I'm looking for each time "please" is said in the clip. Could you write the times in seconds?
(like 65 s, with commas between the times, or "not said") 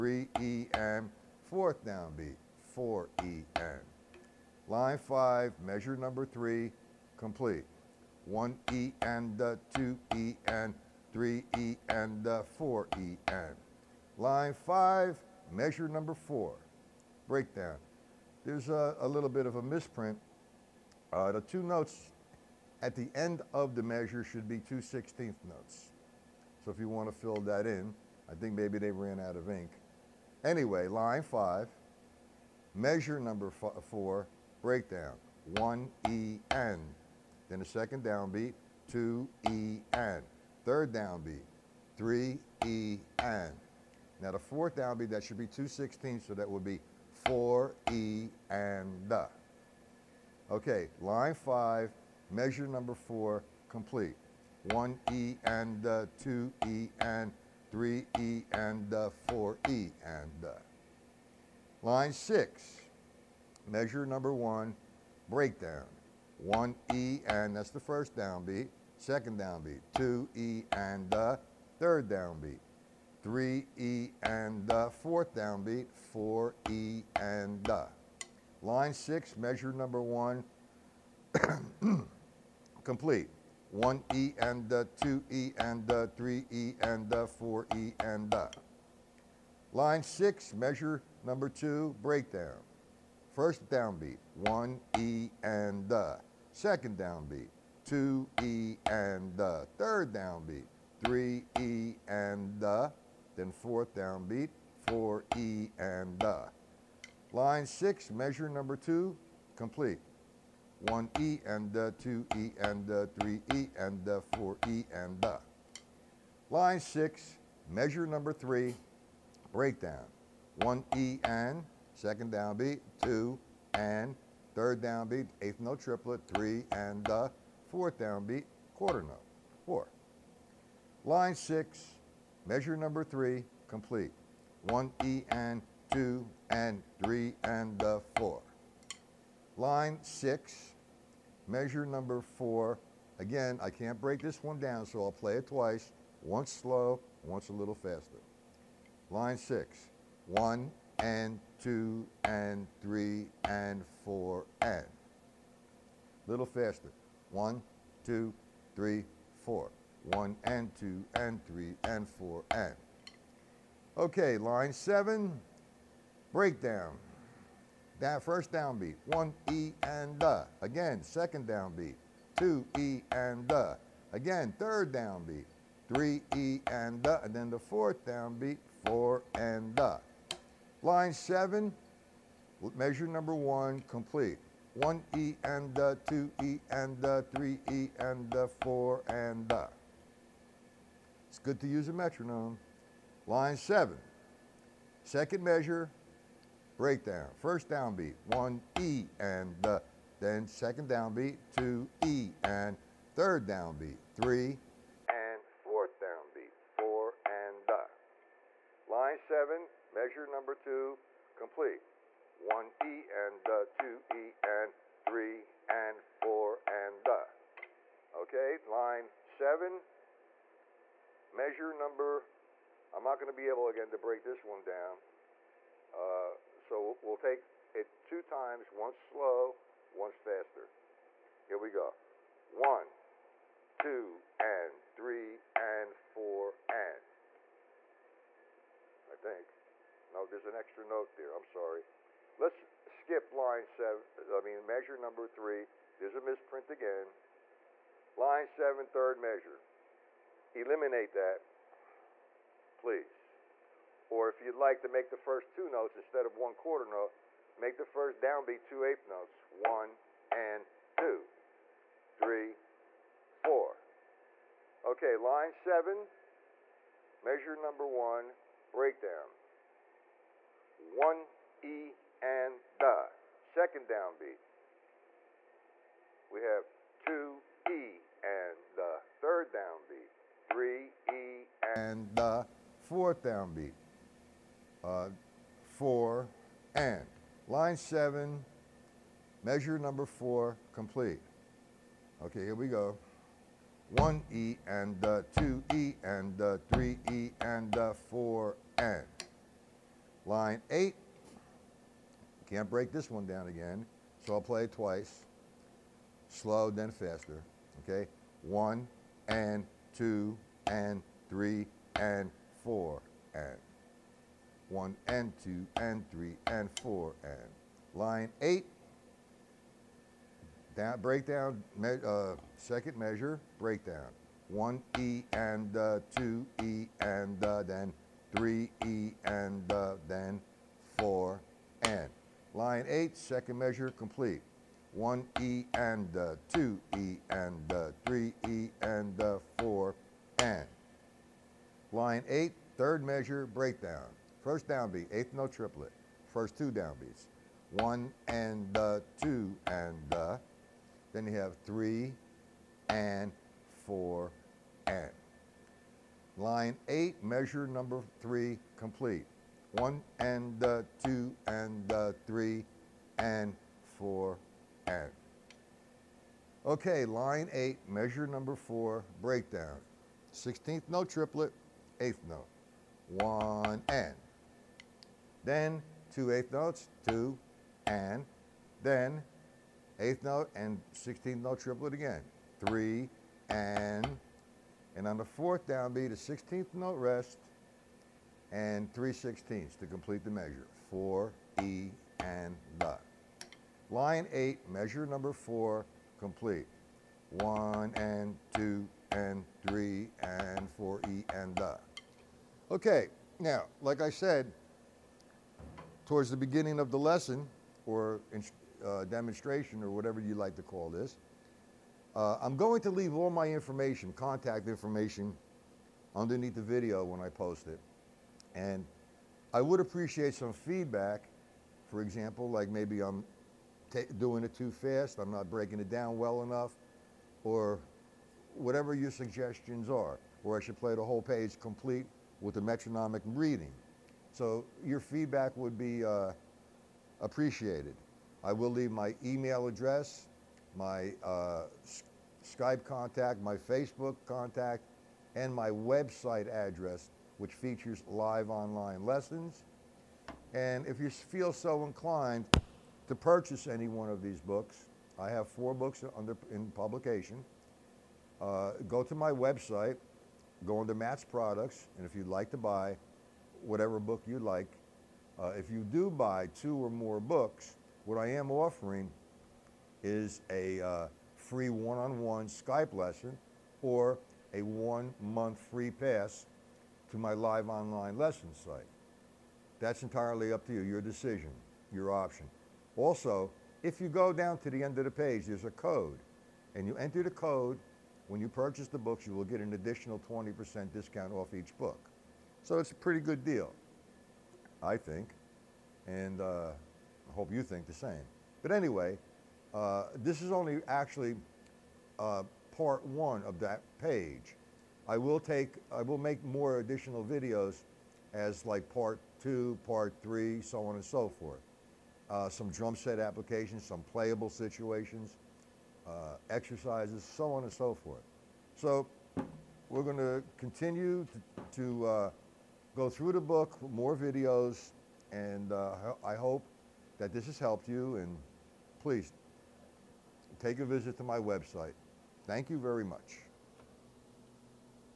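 252 s, 529 s.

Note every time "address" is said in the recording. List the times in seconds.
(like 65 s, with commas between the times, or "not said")
439 s, 446 s.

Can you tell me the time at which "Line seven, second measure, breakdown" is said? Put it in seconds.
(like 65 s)
193 s.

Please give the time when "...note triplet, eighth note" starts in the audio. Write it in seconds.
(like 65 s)
370 s.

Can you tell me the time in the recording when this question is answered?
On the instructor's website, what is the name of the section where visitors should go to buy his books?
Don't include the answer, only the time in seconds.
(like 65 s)
460 s.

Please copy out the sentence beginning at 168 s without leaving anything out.
That first down beat, one E and the.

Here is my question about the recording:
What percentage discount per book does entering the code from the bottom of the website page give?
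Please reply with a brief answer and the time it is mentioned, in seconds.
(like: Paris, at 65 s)
20%, at 490 s.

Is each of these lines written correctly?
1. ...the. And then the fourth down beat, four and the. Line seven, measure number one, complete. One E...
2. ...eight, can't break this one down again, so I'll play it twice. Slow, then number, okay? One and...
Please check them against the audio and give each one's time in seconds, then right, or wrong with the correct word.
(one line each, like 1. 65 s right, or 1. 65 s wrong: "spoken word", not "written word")
1. 177 s right
2. 300 s wrong: "faster", not "number".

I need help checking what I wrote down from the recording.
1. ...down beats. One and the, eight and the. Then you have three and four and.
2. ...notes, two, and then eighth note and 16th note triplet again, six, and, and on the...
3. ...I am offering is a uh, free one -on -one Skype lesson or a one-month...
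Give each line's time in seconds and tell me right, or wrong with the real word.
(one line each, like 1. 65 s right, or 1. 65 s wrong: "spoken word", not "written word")
1. 346 s wrong: "two", not "eight"
2. 376 s wrong: "three", not "six"
3. 468 s right.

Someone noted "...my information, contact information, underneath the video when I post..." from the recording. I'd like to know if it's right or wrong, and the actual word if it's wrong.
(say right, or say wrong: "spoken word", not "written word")
right.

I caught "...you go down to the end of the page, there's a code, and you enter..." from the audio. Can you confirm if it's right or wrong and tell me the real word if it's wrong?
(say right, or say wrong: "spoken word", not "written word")
right.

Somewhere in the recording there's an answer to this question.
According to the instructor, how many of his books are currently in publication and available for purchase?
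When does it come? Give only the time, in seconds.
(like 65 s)
455 s.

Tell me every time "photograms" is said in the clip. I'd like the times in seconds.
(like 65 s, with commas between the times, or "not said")
not said.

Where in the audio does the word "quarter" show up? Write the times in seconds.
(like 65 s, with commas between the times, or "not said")
128 s, 256 s.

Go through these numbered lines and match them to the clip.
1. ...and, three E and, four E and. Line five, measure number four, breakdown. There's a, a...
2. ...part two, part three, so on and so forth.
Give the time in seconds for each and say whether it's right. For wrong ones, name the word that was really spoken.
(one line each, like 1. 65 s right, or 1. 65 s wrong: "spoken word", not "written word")
1. 10 s right
2. 508 s right.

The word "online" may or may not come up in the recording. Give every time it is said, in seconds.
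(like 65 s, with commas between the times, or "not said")
448 s, 477 s.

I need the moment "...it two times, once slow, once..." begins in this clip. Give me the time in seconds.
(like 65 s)
227 s.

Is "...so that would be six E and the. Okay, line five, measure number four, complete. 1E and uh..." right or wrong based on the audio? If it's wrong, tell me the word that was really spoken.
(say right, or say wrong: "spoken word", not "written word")
wrong: "four", not "six".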